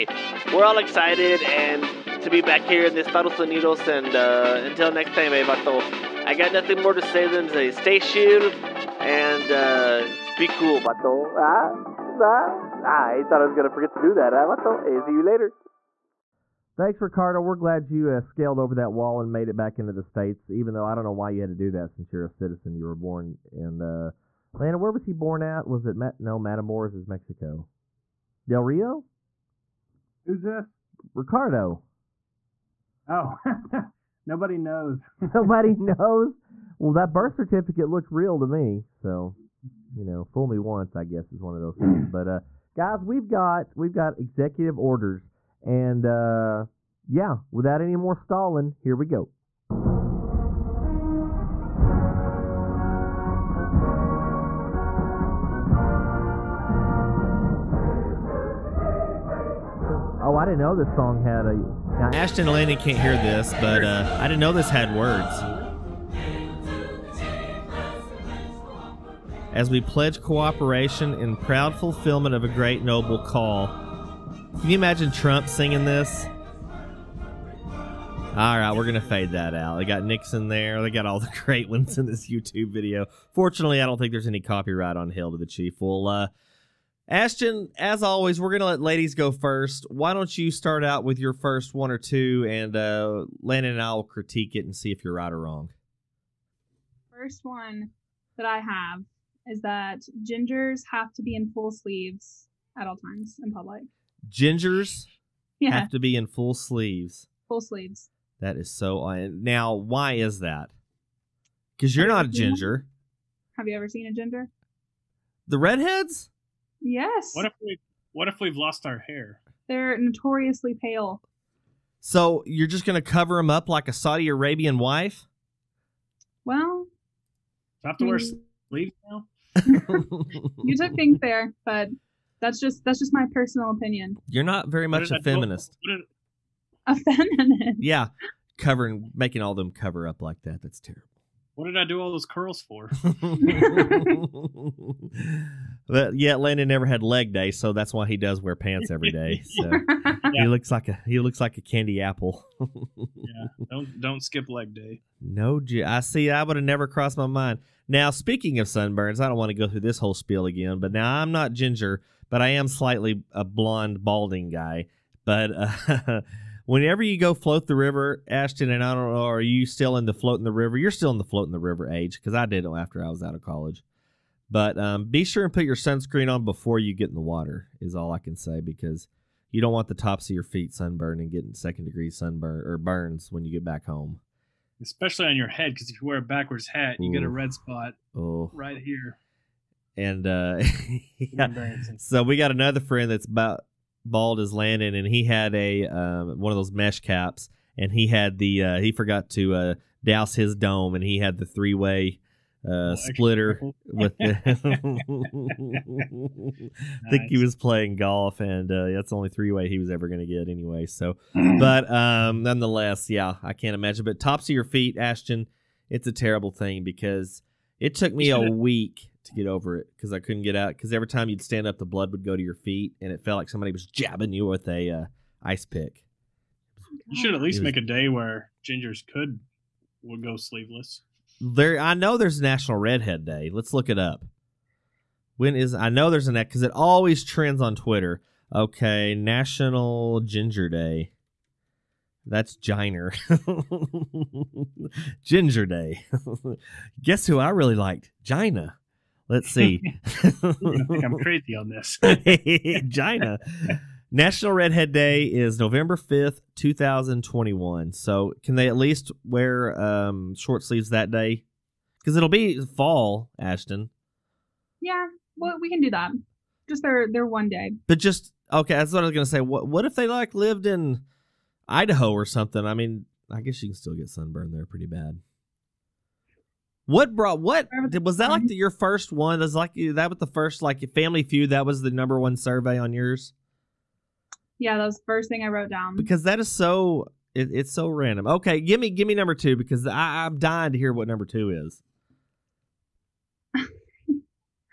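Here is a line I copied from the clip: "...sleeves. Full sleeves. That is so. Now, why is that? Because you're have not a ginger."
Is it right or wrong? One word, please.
right.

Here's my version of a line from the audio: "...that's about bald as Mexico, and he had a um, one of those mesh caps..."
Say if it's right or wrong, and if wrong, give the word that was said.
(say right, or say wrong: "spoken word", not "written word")
wrong: "Landon", not "Mexico".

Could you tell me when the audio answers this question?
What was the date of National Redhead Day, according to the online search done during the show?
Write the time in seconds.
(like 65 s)
255 s.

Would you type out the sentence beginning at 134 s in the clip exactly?
You're not very much a feminist.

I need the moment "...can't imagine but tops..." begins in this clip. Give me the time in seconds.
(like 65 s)
213 s.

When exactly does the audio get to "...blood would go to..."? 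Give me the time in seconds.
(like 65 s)
221 s.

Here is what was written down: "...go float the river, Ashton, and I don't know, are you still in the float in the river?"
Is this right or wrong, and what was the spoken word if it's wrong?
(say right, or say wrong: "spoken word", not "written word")
right.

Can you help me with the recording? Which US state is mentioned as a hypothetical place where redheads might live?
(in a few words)
Idaho.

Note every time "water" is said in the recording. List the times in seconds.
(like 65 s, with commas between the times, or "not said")
177 s.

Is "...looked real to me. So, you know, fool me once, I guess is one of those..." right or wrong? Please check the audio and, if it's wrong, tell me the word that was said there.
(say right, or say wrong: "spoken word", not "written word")
right.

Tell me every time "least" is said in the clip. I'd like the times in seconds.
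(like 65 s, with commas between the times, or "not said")
227 s, 258 s.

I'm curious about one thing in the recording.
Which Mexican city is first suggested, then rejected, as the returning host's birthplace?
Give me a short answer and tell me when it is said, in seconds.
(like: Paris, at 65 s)
Matamoros, at 26 s.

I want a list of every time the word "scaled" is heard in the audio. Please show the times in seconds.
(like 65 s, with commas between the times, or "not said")
18 s.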